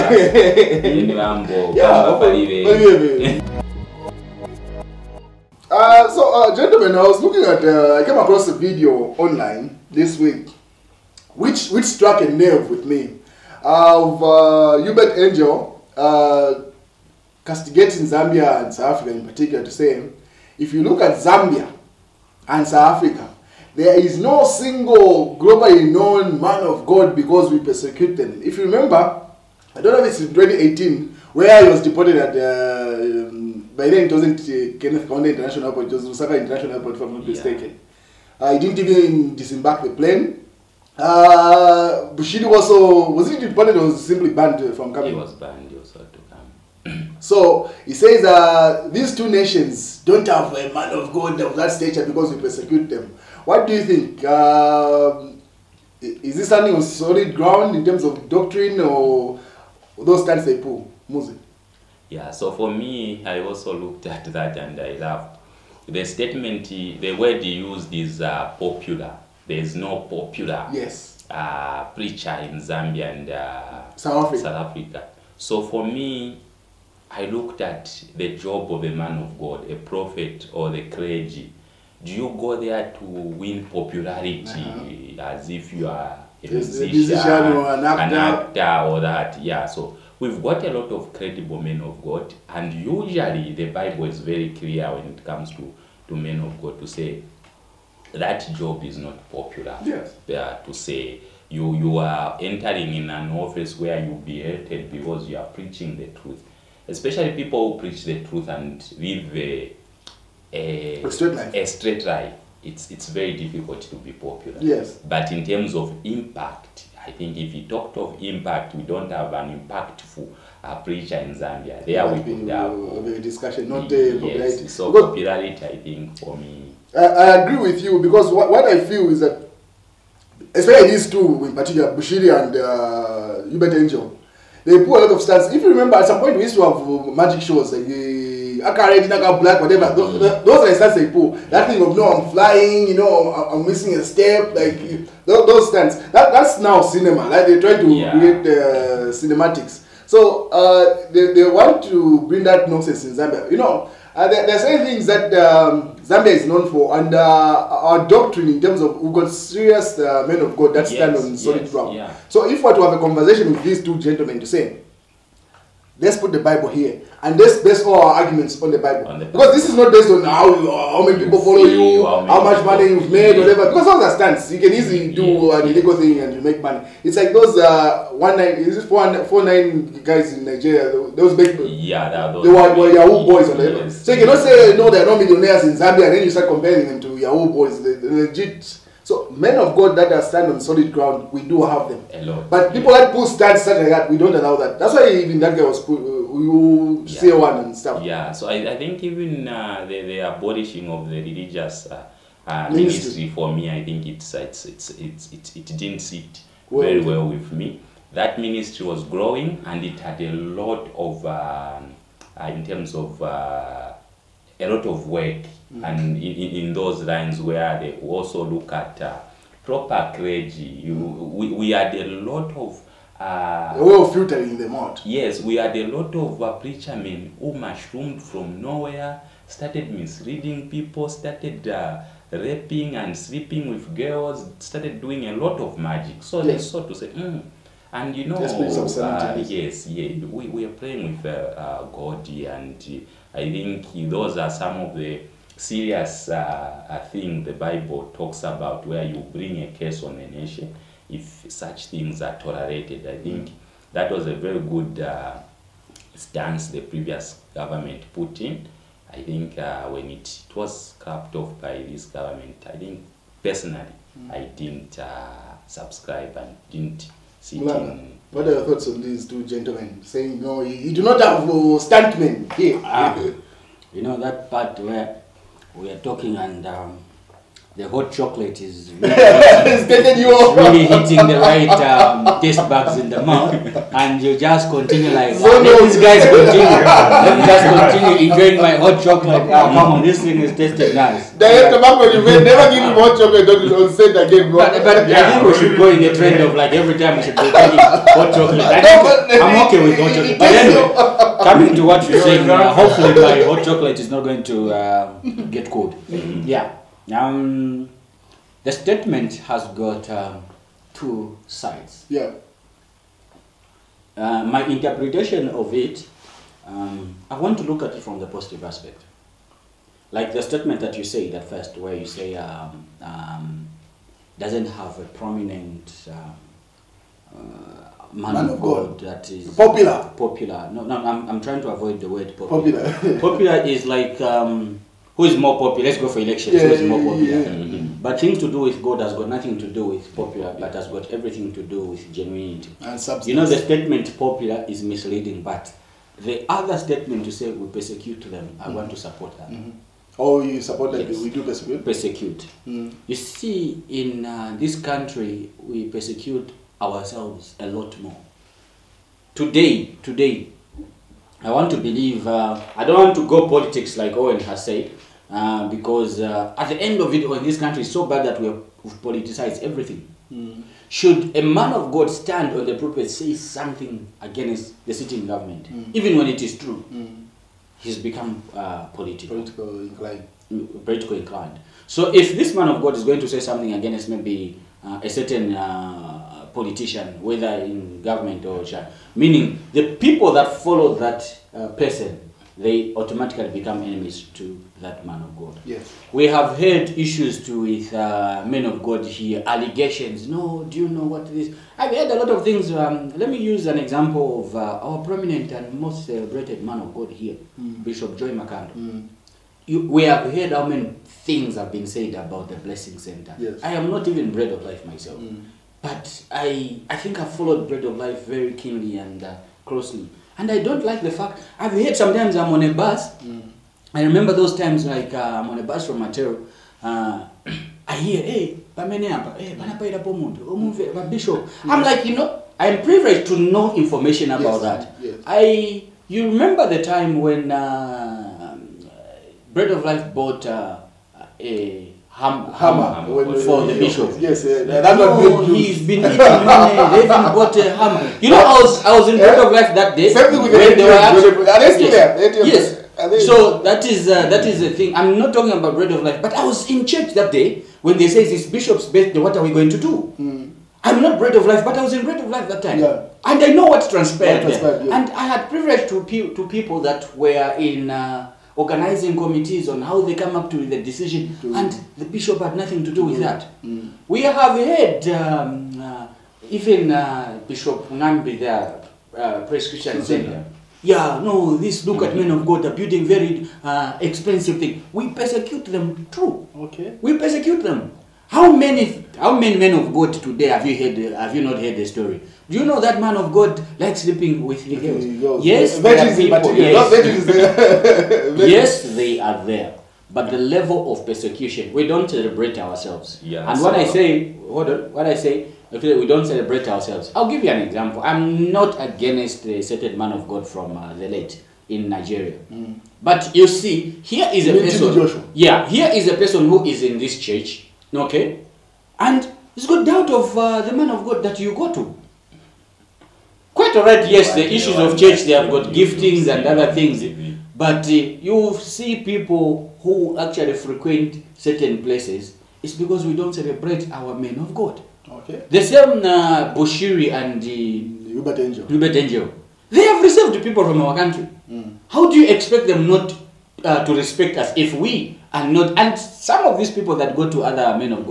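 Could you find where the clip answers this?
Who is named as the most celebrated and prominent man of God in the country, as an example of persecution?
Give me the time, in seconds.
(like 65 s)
407 s.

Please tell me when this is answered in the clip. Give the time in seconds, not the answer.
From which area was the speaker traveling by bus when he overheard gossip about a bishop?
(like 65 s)
425 s.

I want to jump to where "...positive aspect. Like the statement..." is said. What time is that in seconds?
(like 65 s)
318 s.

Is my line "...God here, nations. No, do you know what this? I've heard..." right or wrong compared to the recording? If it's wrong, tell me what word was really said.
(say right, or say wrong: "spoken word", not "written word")
wrong: "allegations", not "nations".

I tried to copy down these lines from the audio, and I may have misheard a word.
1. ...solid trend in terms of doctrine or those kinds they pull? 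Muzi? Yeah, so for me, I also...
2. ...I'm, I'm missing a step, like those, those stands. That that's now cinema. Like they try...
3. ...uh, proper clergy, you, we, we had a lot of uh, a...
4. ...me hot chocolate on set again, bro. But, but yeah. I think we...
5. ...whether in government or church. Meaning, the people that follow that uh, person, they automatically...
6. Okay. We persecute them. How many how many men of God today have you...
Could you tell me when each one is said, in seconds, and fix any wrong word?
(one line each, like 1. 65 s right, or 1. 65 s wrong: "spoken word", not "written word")
1. 56 s wrong: "ground", not "trend"
2. 143 s right
3. 219 s right
4. 292 s right
5. 387 s right
6. 486 s right.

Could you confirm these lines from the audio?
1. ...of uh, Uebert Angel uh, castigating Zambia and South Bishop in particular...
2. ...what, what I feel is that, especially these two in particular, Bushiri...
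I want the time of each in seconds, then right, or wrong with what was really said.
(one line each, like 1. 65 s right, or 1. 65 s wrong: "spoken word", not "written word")
1. 13 s wrong: "Africa", not "Bishop"
2. 128 s right.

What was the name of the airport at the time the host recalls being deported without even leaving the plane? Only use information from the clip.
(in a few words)
Lusaka International Airport.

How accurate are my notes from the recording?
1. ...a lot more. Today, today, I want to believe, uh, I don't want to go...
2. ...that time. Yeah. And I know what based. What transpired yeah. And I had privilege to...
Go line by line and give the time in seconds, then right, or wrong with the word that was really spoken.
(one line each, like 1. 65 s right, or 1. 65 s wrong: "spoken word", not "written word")
1. 357 s right
2. 462 s wrong: "transpired", not "based".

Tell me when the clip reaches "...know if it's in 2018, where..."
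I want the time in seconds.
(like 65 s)
29 s.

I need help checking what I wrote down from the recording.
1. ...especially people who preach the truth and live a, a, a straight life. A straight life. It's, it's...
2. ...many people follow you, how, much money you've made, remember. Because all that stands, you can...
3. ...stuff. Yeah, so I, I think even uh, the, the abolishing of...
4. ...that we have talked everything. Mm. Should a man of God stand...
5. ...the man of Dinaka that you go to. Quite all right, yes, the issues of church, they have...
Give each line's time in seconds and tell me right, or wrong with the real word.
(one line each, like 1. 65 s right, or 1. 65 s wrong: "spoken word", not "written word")
1. 106 s right
2. 171 s wrong: "whatever", not "remember"
3. 197 s right
4. 368 s wrong: "politicized", not "talked"
5. 520 s wrong: "God", not "Dinaka".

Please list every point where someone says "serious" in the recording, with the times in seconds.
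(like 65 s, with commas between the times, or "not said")
159 s, 245 s.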